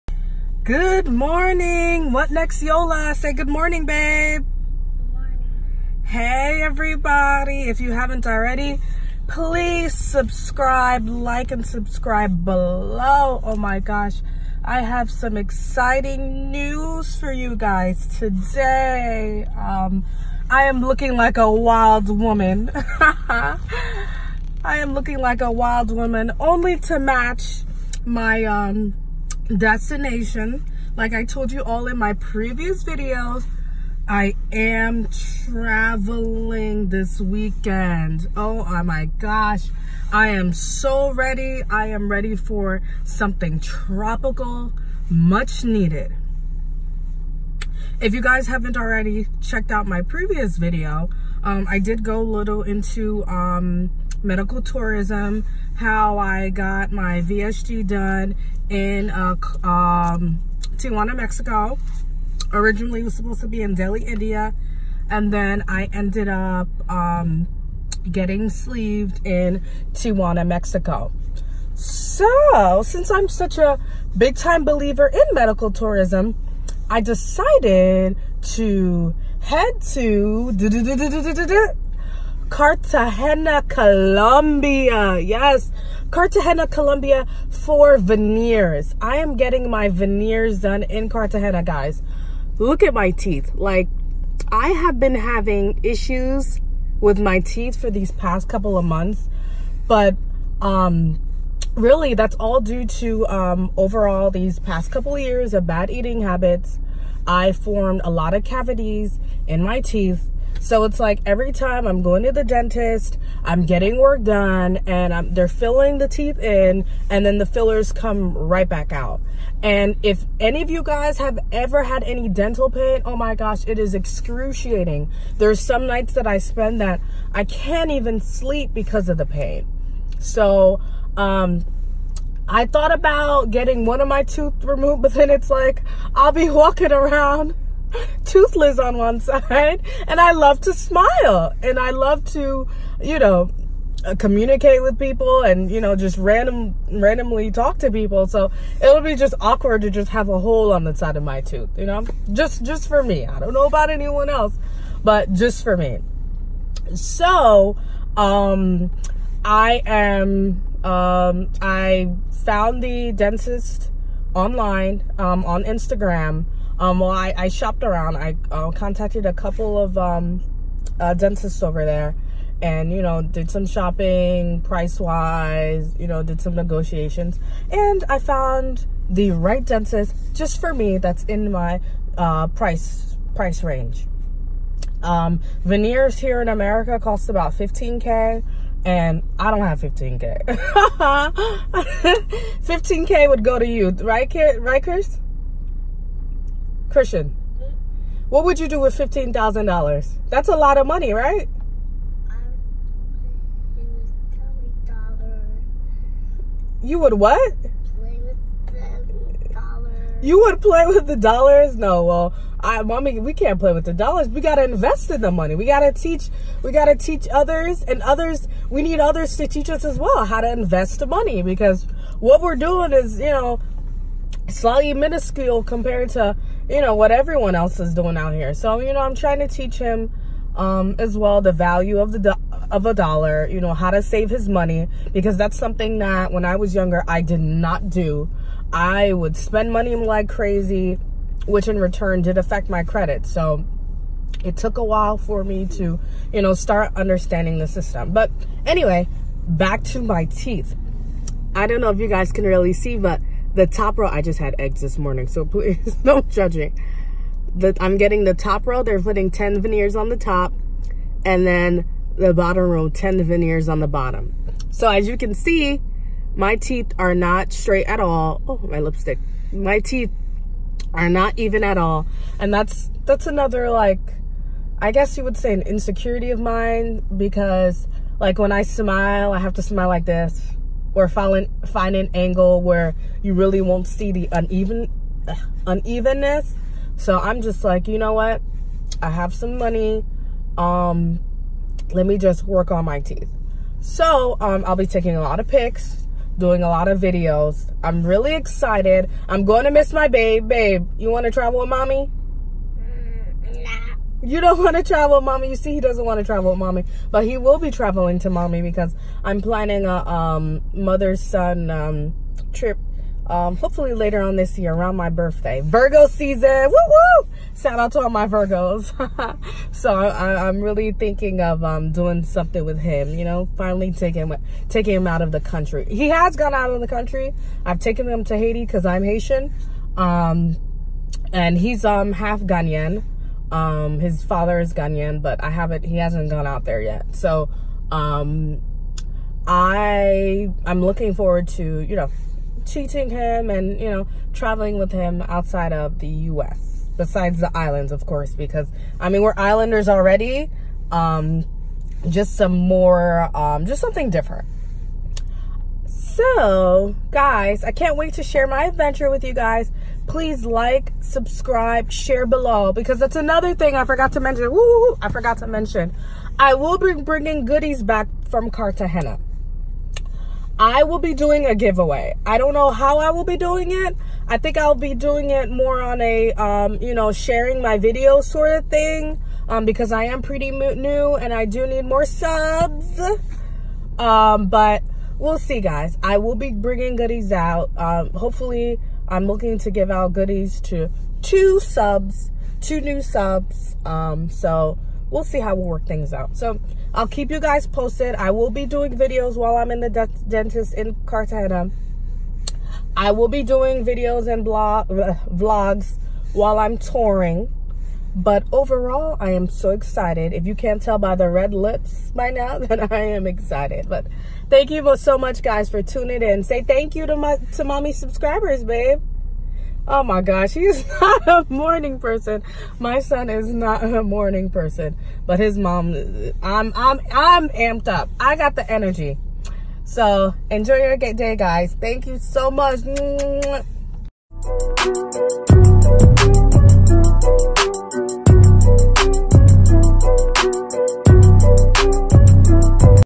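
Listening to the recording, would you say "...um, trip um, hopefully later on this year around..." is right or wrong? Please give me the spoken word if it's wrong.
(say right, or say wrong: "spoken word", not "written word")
right.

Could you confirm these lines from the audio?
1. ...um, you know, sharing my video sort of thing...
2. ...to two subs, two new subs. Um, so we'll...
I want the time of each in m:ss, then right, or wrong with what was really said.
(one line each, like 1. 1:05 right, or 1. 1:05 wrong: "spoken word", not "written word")
1. 6:16 right
2. 6:30 right.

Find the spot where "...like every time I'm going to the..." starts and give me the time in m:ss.
1:50.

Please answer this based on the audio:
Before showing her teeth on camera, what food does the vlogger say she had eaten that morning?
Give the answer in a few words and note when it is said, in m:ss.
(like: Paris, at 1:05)
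Eggs, at 4:14.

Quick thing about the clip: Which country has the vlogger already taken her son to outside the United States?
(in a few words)
Haiti.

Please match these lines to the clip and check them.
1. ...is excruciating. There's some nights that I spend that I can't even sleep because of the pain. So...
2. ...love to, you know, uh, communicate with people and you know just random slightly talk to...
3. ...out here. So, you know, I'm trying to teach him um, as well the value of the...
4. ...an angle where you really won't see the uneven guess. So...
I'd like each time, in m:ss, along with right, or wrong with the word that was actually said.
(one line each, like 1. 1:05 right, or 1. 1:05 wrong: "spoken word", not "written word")
1. 2:03 right
2. 2:21 wrong: "randomly", not "slightly"
3. 3:48 right
4. 4:41 wrong: "unevenness", not "guess".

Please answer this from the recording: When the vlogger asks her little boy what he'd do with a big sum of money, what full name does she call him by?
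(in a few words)
Christian.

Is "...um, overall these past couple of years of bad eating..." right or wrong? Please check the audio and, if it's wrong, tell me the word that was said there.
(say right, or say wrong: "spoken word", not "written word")
right.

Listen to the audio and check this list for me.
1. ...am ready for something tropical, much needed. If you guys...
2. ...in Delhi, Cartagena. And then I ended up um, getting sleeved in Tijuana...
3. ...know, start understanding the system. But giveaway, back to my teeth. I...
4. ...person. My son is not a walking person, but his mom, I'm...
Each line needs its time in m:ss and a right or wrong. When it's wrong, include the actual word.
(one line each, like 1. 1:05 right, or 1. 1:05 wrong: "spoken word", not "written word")
1. 0:41 right
2. 1:03 wrong: "India", not "Cartagena"
3. 4:06 wrong: "anyway", not "giveaway"
4. 7:01 wrong: "morning", not "walking".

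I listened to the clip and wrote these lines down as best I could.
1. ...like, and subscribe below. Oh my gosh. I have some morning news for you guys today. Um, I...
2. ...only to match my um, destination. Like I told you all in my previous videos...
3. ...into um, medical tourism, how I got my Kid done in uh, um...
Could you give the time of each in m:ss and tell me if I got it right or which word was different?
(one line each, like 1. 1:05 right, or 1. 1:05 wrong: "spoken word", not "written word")
1. 0:11 wrong: "exciting", not "morning"
2. 0:26 right
3. 0:52 wrong: "VSG", not "Kid".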